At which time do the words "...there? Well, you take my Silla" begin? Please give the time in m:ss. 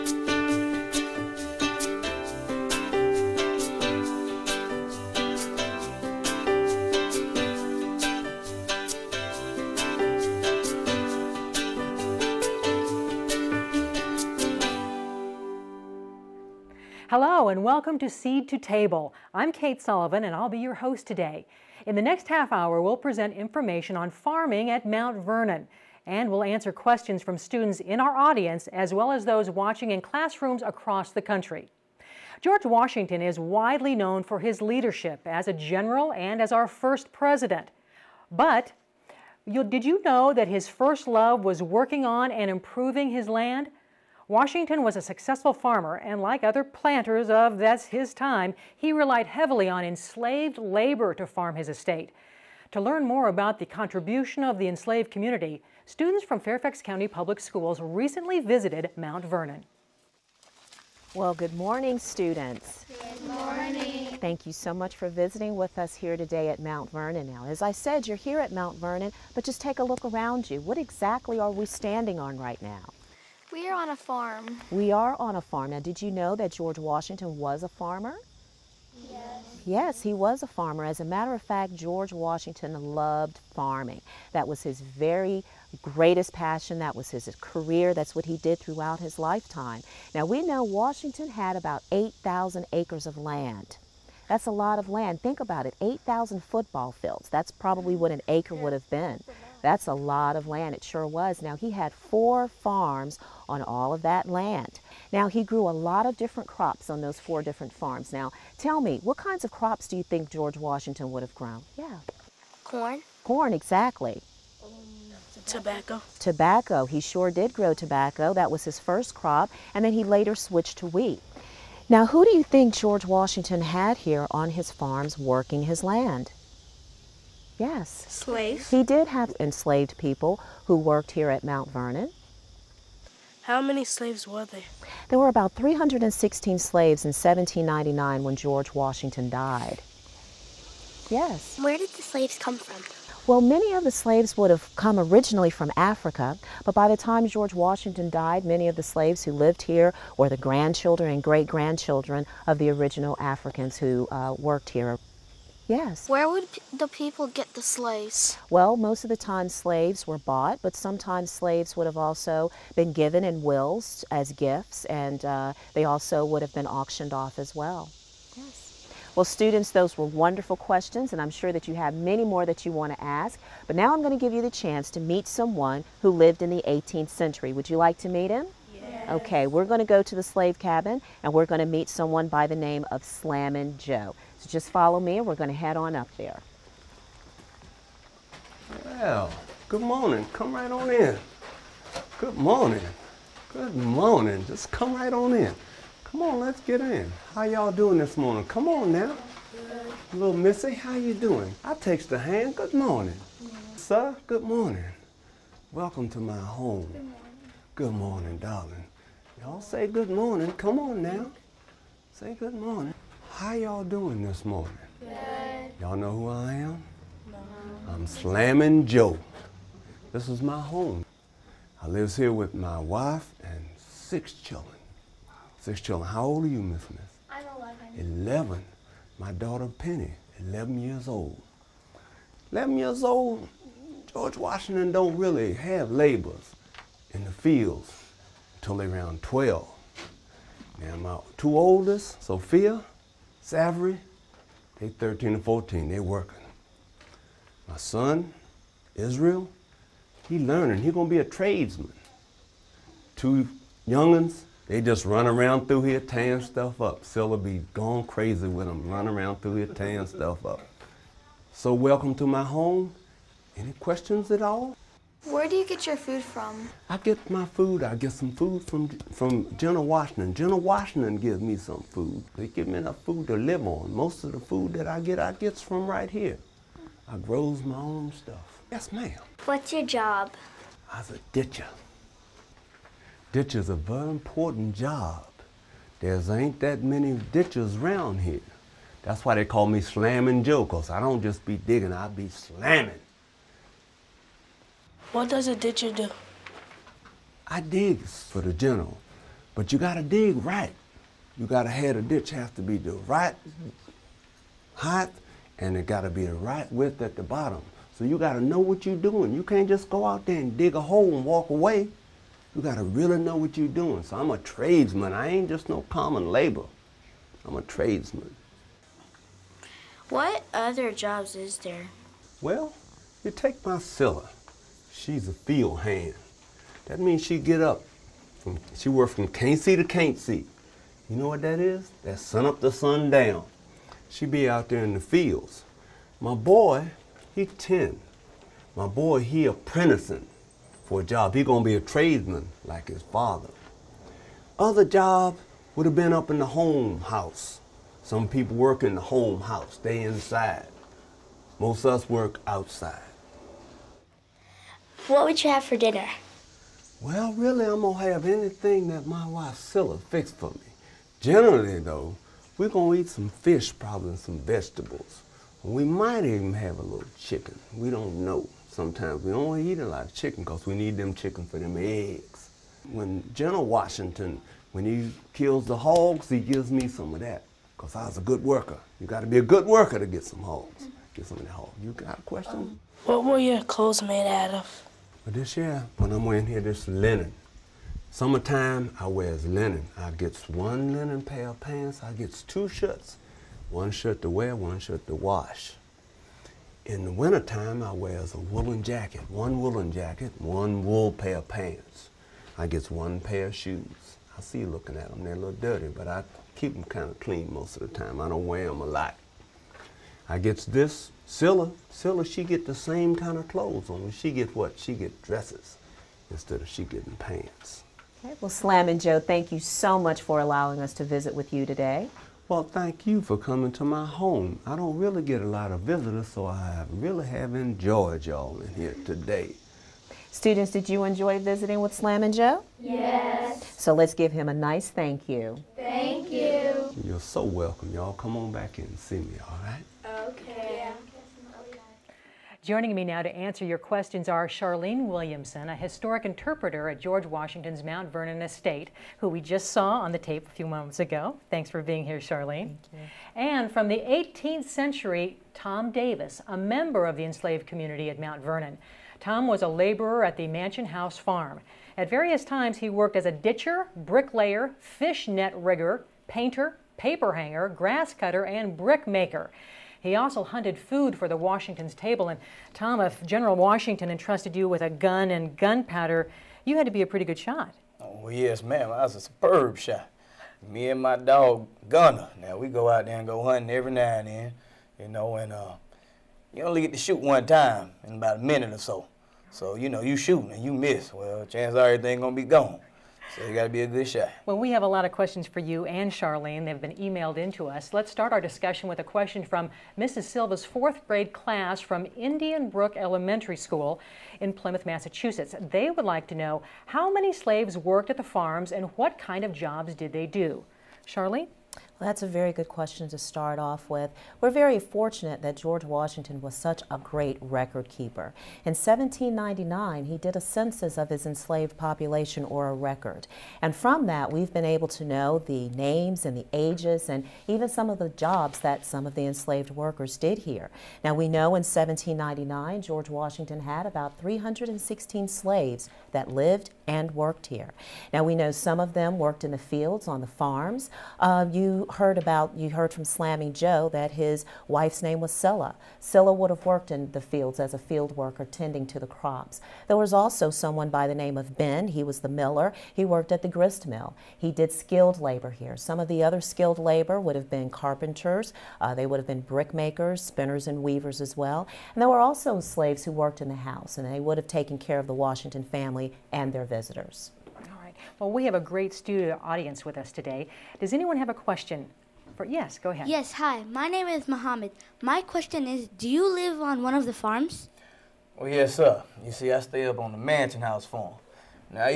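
5:21.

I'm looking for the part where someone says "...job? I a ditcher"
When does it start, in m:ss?
4:39.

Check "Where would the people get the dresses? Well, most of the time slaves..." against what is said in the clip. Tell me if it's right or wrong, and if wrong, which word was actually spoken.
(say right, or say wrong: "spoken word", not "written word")
wrong: "slaves", not "dresses".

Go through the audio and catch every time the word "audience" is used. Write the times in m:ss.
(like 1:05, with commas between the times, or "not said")
0:28, 9:29.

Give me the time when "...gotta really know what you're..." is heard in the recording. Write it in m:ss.
5:12.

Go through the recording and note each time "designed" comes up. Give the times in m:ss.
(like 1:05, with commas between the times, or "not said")
not said.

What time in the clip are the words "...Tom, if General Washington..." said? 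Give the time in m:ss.
7:52.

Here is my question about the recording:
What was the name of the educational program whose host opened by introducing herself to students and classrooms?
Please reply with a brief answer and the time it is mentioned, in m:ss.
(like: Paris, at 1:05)
Seed to Table, at 0:18.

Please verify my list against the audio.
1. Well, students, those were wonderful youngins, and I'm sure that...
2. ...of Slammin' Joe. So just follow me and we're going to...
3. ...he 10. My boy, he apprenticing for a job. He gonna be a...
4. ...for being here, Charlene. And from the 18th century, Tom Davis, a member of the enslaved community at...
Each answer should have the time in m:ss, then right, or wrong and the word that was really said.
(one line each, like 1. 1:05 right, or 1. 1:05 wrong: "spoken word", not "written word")
1. 2:49 wrong: "questions", not "youngins"
2. 3:02 right
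3. 5:37 right
4. 7:31 right.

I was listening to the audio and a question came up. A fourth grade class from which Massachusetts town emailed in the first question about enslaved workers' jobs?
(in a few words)
Plymouth.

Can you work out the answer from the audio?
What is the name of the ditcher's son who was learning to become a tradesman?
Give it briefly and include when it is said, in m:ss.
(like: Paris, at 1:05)
Israel, at 4:08.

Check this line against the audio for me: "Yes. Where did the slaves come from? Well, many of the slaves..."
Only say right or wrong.
right.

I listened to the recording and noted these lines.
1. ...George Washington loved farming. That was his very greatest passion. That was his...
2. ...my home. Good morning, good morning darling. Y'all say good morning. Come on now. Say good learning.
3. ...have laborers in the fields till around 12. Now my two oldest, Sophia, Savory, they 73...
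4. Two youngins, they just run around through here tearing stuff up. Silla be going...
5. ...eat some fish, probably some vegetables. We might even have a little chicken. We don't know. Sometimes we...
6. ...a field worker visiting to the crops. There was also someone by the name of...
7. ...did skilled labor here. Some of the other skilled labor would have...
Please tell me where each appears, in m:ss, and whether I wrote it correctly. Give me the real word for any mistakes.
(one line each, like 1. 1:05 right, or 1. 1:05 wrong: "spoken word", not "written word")
1. 1:21 right
2. 3:26 wrong: "morning", not "learning"
3. 3:55 wrong: "13", not "73"
4. 4:13 right
5. 6:03 right
6. 9:07 wrong: "tending", not "visiting"
7. 9:14 right.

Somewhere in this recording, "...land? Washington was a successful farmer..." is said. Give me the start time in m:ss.
0:43.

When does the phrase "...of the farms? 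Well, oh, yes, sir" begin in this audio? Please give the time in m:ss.
9:36.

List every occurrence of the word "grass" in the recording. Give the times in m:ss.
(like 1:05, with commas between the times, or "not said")
7:47.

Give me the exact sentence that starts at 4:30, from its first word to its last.
General Washington gives me some food.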